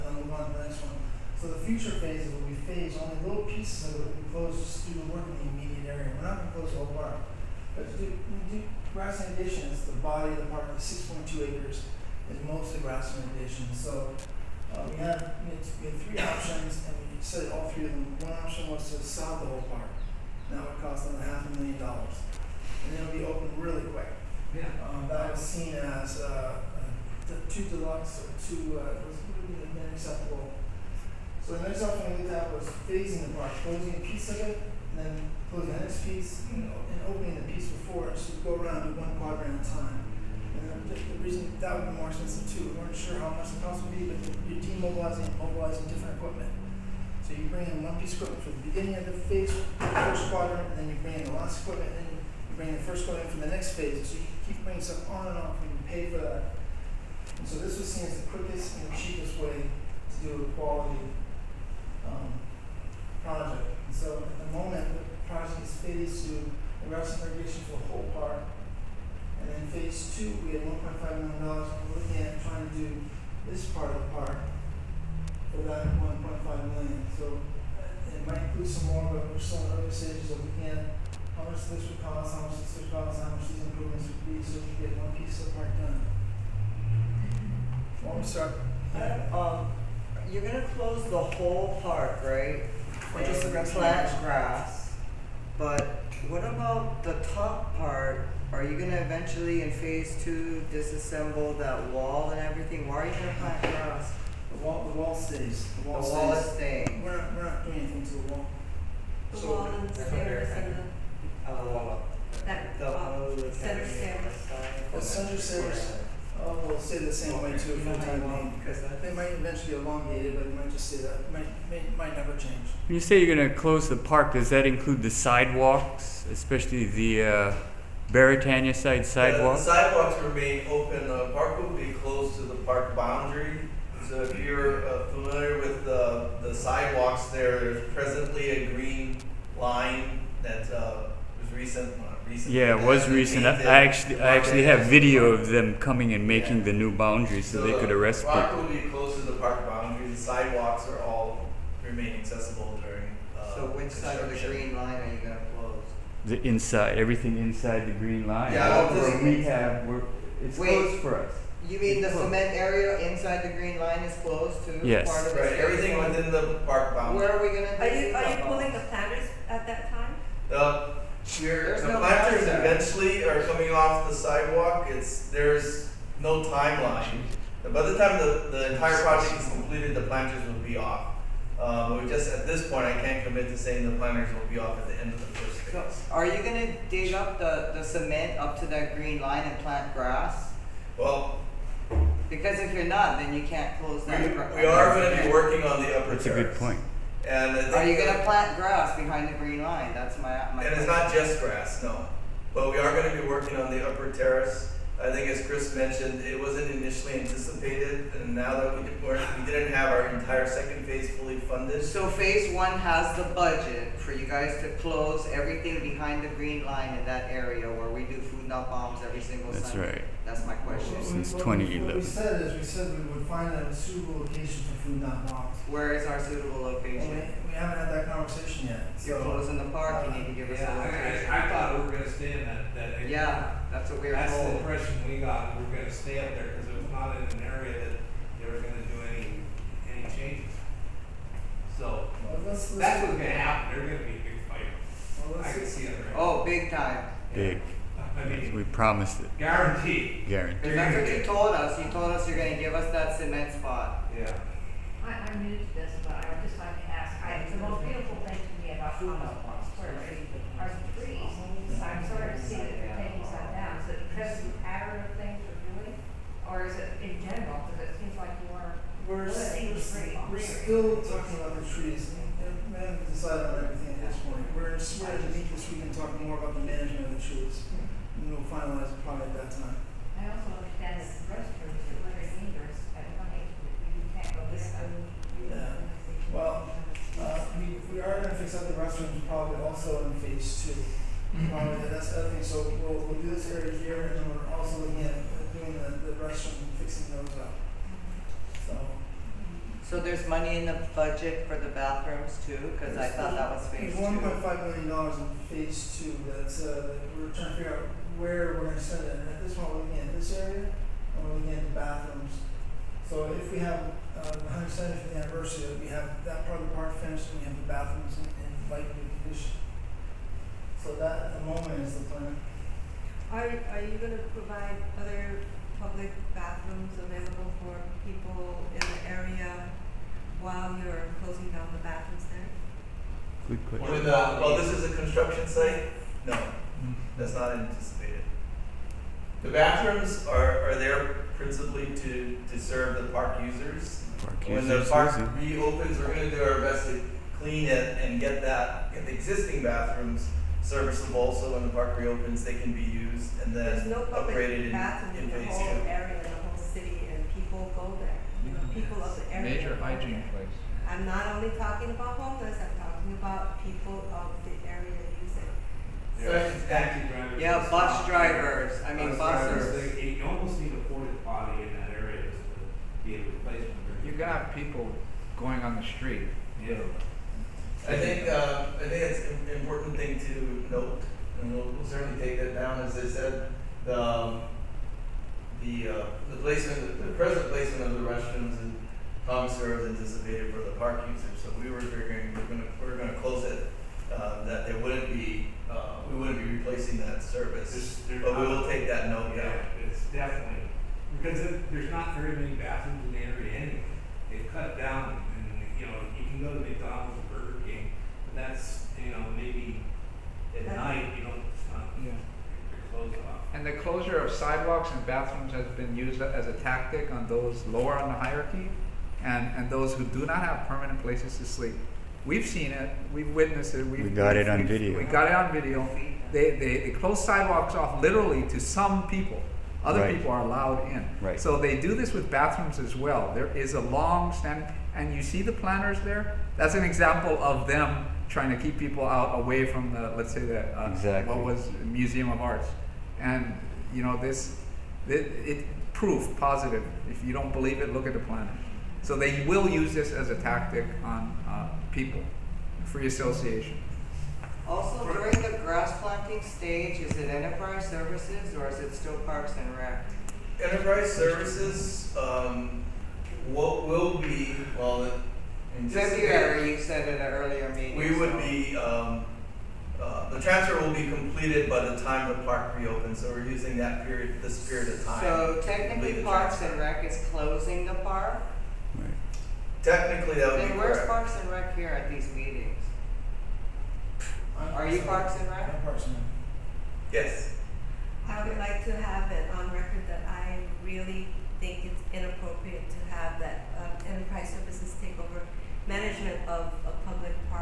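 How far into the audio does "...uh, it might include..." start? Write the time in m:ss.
1:17.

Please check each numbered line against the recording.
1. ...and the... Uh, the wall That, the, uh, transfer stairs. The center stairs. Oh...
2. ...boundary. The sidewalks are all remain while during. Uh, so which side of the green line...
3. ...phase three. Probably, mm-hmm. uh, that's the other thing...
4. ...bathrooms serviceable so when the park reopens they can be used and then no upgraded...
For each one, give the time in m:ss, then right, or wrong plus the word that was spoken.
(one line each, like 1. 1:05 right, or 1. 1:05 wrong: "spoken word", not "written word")
1. 1:50 wrong: "center", not "transfer"
2. 2:29 wrong: "accessible", not "while"
3. 4:50 wrong: "two", not "three"
4. 5:49 right.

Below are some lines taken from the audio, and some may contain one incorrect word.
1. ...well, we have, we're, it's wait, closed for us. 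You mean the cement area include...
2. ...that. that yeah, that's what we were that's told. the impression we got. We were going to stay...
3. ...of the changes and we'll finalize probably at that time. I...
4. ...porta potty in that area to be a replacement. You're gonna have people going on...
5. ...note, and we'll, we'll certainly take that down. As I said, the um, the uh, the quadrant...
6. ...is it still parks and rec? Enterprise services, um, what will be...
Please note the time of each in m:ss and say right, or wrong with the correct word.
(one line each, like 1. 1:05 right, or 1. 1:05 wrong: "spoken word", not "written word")
1. 2:38 wrong: "inside", not "include"
2. 3:52 right
3. 4:37 wrong: "trees", not "changes"
4. 6:10 right
5. 6:20 wrong: "placement", not "quadrant"
6. 7:38 right.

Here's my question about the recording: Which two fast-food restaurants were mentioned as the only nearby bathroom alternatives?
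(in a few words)
McDonald's and Burger King.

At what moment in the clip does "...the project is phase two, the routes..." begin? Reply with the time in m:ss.
1:04.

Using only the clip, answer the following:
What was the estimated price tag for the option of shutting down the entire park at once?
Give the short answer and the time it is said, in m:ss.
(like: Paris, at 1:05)
half a million dollars, at 0:21.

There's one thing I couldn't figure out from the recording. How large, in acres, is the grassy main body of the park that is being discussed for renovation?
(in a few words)
6.2 acres.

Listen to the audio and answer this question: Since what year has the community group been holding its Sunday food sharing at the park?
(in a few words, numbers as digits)
2011.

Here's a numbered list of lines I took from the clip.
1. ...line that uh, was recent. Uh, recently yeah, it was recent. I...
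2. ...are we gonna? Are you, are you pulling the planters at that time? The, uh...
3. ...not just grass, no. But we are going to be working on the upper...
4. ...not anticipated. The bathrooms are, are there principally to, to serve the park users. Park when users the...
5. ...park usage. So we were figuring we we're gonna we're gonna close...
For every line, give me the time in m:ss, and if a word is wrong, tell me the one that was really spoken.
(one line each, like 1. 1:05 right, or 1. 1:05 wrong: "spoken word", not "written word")
1. 2:19 right
2. 2:47 right
3. 3:20 right
4. 5:37 right
5. 6:30 right.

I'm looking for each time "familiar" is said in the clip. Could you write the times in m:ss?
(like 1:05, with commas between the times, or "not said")
2:15.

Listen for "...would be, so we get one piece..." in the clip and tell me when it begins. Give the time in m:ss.
1:24.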